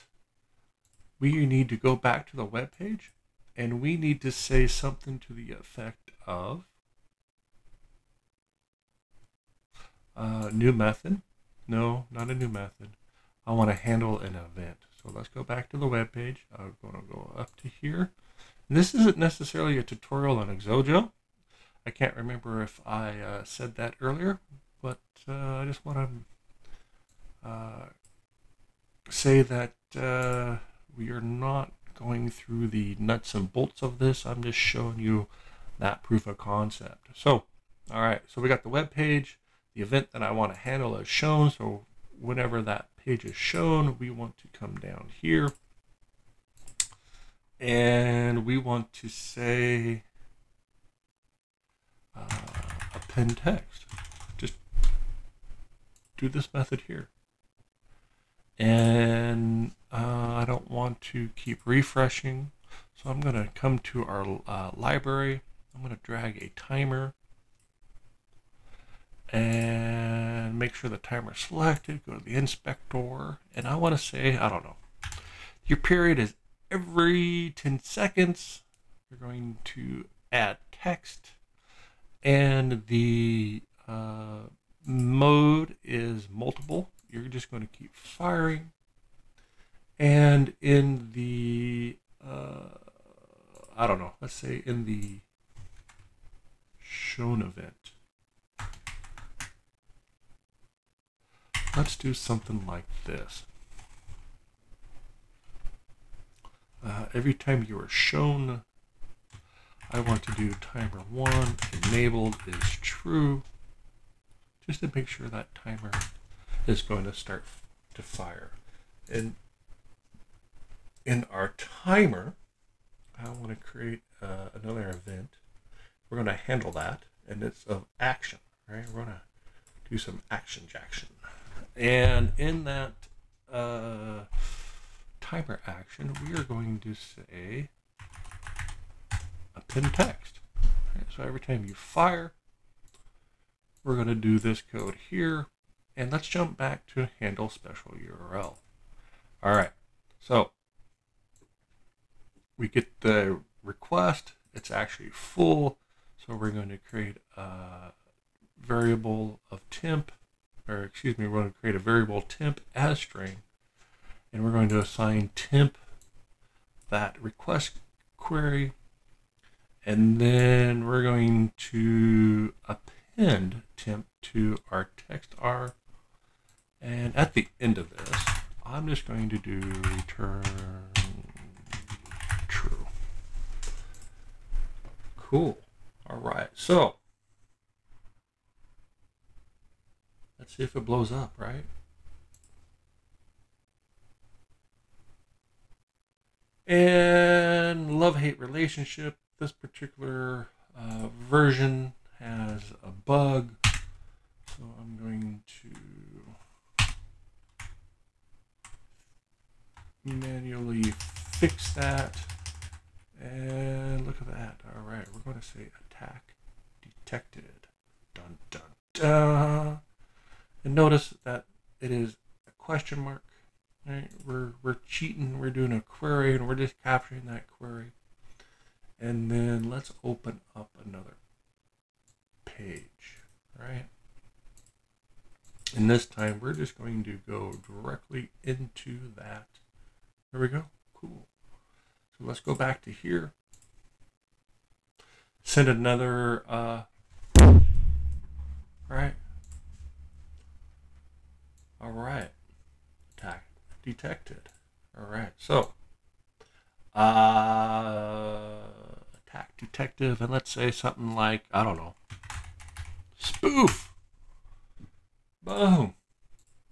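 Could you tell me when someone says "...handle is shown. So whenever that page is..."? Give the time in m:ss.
0:40.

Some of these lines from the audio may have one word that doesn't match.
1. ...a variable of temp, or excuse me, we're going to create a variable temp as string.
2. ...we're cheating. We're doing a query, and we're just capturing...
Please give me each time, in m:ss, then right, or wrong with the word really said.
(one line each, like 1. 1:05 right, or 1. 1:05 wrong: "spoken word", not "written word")
1. 2:37 right
2. 3:44 right.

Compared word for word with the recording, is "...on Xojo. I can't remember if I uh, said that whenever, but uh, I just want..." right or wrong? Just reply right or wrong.
wrong.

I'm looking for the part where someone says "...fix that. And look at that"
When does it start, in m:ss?
3:31.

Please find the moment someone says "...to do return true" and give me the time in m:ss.
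2:59.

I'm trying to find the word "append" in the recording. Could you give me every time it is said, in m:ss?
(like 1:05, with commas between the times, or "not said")
0:52, 2:19, 2:52.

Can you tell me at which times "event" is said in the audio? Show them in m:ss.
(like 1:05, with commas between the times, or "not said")
0:14, 0:39, 1:37, 2:04.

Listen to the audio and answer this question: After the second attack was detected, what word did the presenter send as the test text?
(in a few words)
spoof.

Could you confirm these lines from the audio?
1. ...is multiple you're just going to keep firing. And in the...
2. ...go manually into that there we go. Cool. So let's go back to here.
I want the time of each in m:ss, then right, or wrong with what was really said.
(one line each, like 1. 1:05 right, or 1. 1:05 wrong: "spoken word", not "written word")
1. 1:25 right
2. 3:57 wrong: "directly", not "manually".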